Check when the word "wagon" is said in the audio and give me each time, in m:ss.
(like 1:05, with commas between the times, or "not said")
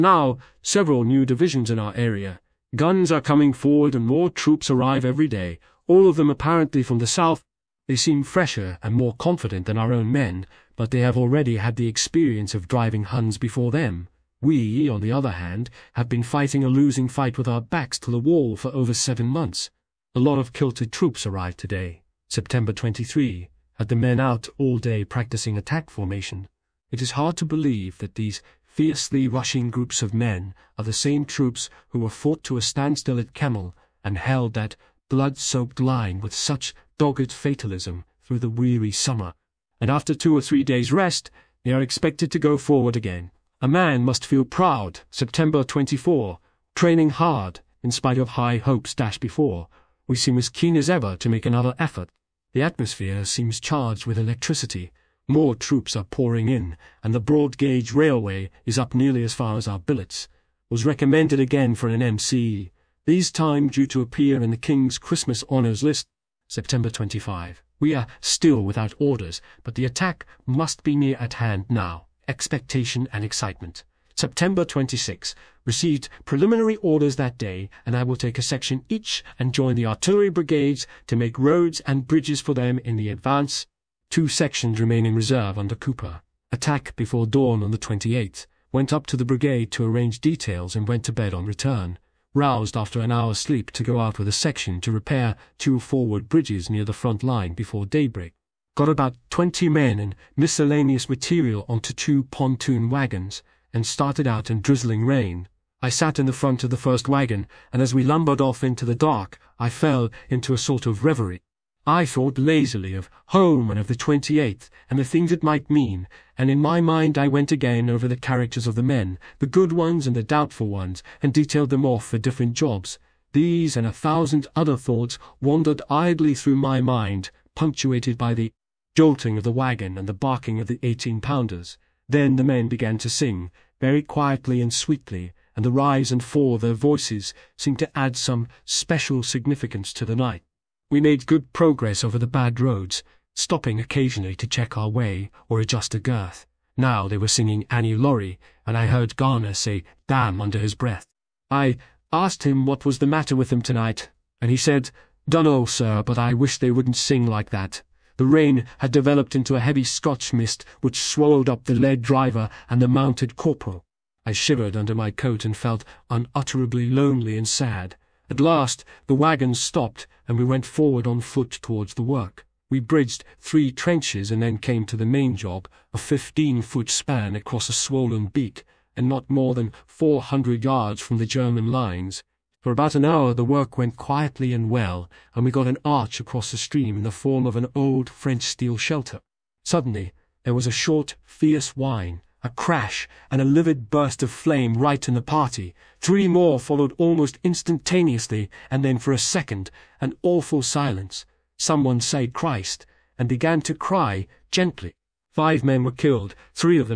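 1:42, 1:47, 2:09, 2:49.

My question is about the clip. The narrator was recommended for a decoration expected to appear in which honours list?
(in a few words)
King's Christmas Honours List.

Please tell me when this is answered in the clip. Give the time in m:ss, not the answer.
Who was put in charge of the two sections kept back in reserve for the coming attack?
1:25.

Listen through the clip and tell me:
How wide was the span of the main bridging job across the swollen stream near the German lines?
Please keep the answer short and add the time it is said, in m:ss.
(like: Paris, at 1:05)
15 feet, at 2:55.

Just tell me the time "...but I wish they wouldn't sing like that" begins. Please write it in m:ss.
2:36.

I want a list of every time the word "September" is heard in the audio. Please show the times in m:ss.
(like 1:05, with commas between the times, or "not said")
0:22, 0:45, 1:06, 1:14.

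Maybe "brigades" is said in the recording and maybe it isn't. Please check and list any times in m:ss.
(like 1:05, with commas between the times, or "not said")
1:20, 1:29.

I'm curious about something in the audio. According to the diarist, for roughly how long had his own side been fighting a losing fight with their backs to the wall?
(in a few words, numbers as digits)
over 7 months.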